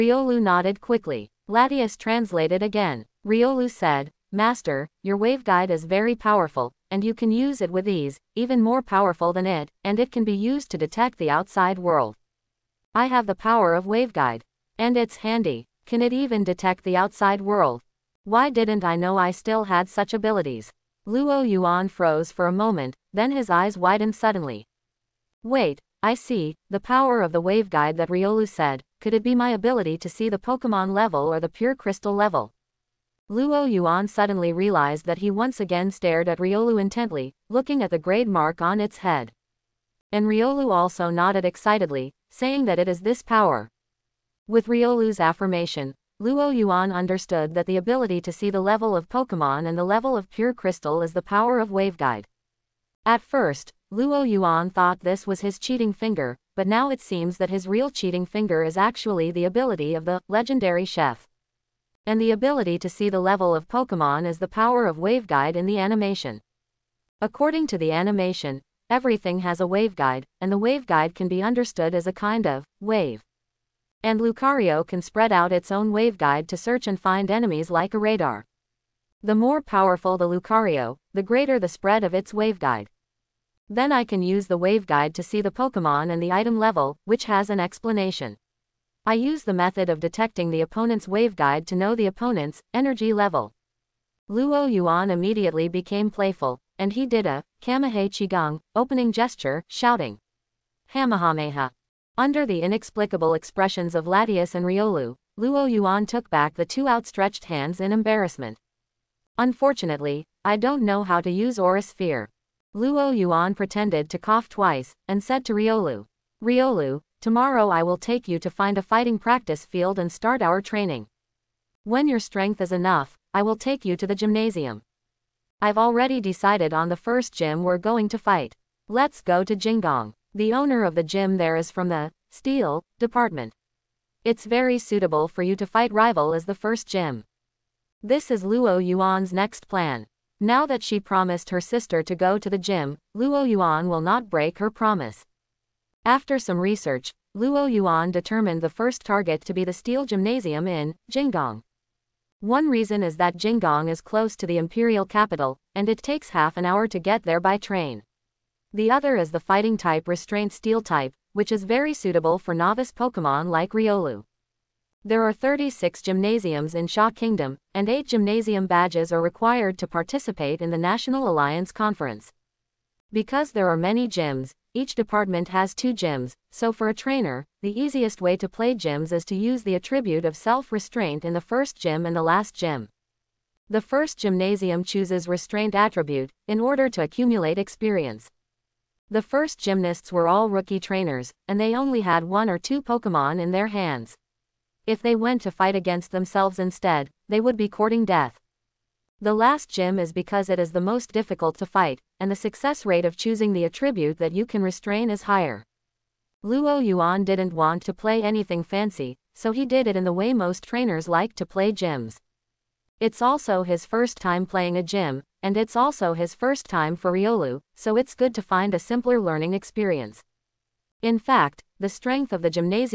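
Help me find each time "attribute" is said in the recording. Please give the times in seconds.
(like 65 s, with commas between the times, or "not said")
179 s, 185 s, 203 s.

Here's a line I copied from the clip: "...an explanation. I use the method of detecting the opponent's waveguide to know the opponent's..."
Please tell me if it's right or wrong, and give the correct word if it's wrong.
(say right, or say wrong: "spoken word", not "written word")
right.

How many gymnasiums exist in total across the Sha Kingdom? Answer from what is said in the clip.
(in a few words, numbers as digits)
36.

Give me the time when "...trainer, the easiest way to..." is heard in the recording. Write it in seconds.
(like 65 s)
176 s.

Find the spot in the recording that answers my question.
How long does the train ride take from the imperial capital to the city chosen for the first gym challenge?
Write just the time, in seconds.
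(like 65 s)
156 s.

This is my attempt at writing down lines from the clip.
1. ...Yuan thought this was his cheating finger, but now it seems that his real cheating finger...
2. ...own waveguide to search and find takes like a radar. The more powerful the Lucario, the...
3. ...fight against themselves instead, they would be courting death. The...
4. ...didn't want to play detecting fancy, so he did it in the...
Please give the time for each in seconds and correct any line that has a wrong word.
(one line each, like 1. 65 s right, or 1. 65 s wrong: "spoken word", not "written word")
1. 54 s right
2. 75 s wrong: "enemies", not "takes"
3. 195 s right
4. 207 s wrong: "anything", not "detecting".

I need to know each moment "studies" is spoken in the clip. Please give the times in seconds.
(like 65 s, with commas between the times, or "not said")
not said.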